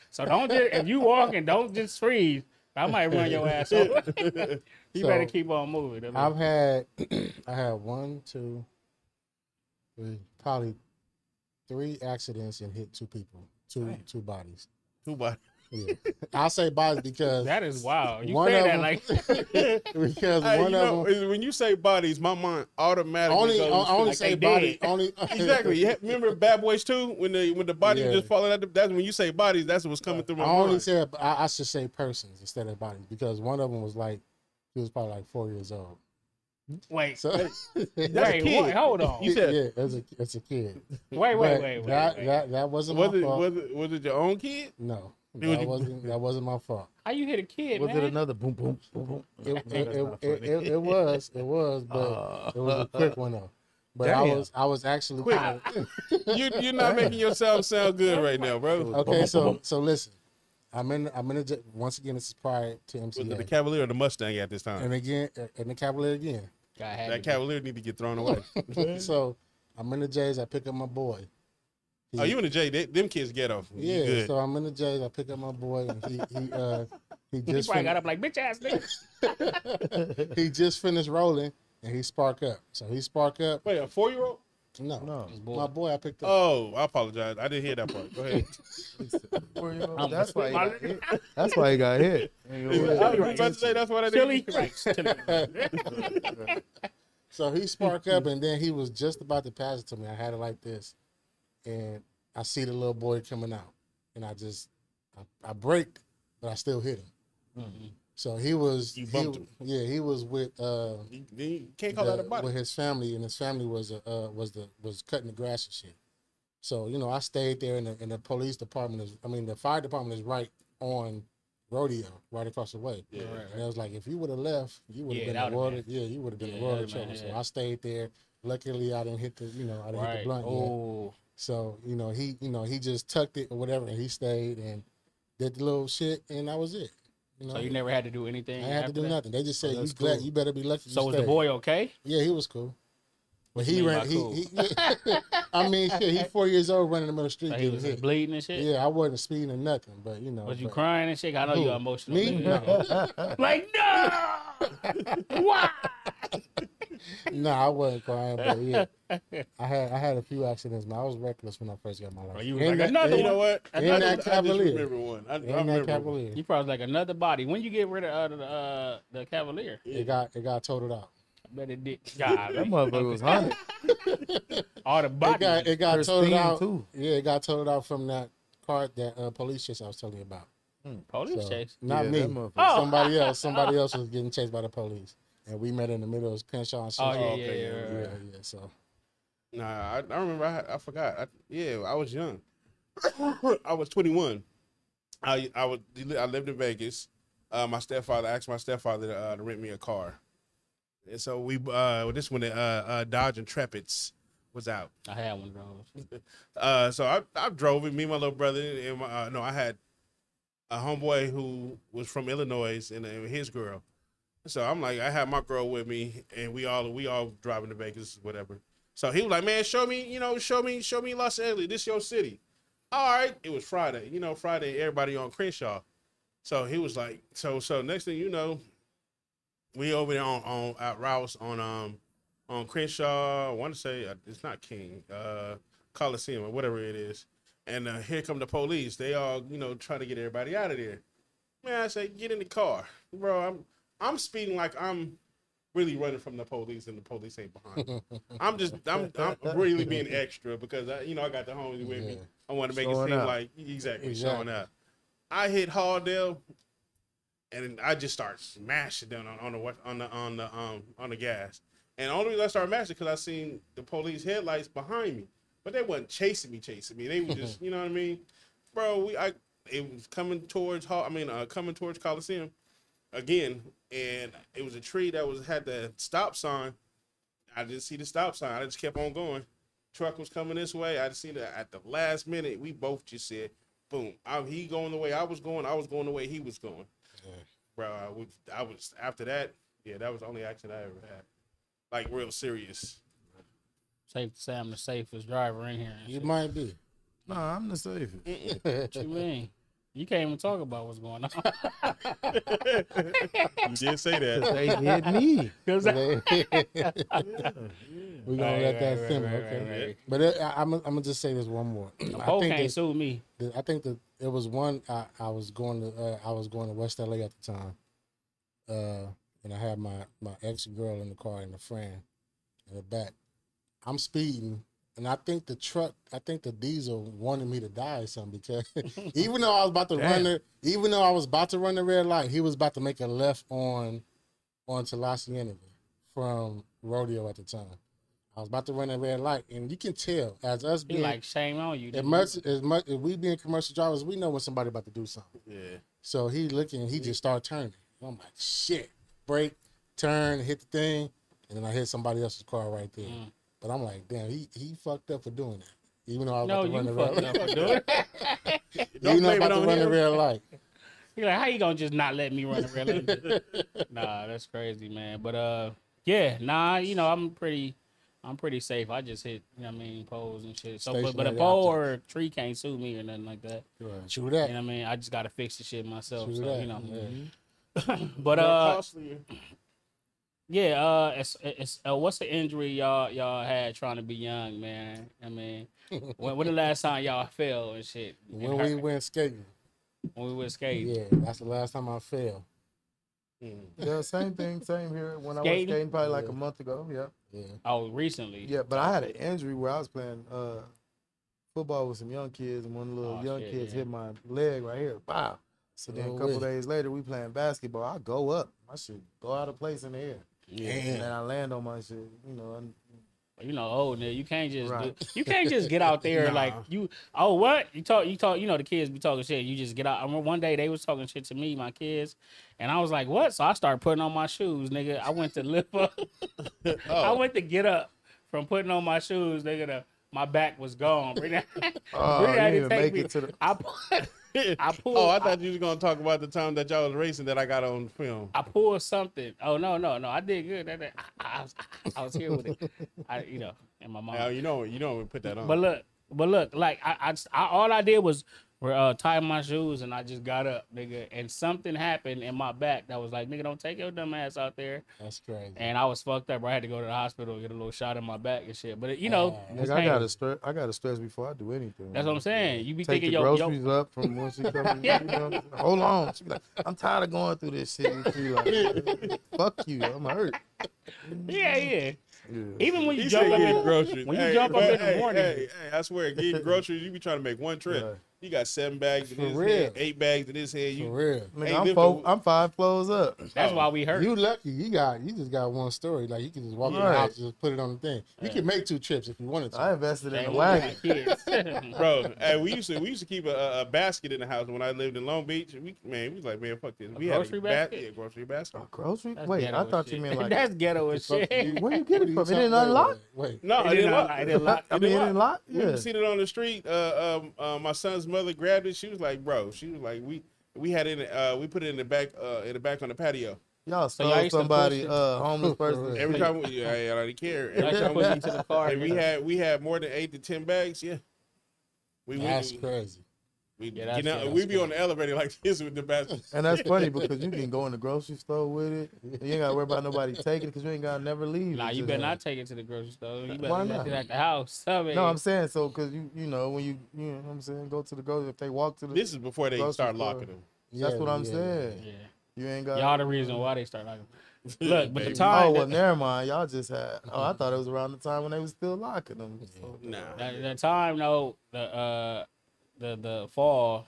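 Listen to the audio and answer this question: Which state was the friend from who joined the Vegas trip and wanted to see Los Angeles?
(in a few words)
Illinois.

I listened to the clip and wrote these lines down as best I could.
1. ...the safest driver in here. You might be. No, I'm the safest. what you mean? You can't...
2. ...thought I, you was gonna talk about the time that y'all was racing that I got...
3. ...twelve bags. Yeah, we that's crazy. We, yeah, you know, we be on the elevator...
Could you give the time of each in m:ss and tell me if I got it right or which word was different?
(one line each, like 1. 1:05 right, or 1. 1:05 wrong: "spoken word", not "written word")
1. 4:54 right
2. 7:15 right
3. 8:40 wrong: "ten", not "twelve".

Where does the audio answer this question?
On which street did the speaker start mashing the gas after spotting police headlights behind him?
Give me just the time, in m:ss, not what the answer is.
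4:15.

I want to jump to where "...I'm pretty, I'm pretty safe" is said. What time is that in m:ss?
6:07.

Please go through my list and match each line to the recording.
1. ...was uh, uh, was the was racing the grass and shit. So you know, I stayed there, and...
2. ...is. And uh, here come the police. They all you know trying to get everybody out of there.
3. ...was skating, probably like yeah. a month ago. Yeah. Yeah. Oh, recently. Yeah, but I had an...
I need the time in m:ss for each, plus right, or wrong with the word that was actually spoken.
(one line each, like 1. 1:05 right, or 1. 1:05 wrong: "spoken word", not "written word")
1. 1:53 wrong: "cutting", not "racing"
2. 3:56 right
3. 6:35 right.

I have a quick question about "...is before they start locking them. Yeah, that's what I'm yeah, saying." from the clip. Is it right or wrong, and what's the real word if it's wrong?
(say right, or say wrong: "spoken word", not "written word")
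right.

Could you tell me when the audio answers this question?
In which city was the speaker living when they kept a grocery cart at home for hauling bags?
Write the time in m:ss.
8:15.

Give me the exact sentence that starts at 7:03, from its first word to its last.
So I started putting on my shoes, nigga.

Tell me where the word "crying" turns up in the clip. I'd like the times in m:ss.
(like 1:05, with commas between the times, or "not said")
2:30, 2:38.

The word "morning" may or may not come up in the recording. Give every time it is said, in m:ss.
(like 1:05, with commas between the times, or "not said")
7:54.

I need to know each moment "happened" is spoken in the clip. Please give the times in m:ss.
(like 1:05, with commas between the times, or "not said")
7:31.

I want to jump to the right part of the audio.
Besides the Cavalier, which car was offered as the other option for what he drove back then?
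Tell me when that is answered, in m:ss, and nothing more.
1:03.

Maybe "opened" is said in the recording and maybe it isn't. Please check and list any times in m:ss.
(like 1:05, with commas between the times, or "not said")
not said.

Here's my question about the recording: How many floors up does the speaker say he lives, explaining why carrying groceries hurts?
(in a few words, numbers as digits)
5.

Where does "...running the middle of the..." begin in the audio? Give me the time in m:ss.
2:26.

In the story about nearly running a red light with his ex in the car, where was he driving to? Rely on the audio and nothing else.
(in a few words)
West LA.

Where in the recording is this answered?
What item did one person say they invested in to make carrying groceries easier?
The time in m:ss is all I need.
8:10.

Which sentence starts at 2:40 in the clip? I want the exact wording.
Man, I was reckless when I first got my license.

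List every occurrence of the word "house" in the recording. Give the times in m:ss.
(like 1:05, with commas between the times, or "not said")
8:06, 8:14, 8:54.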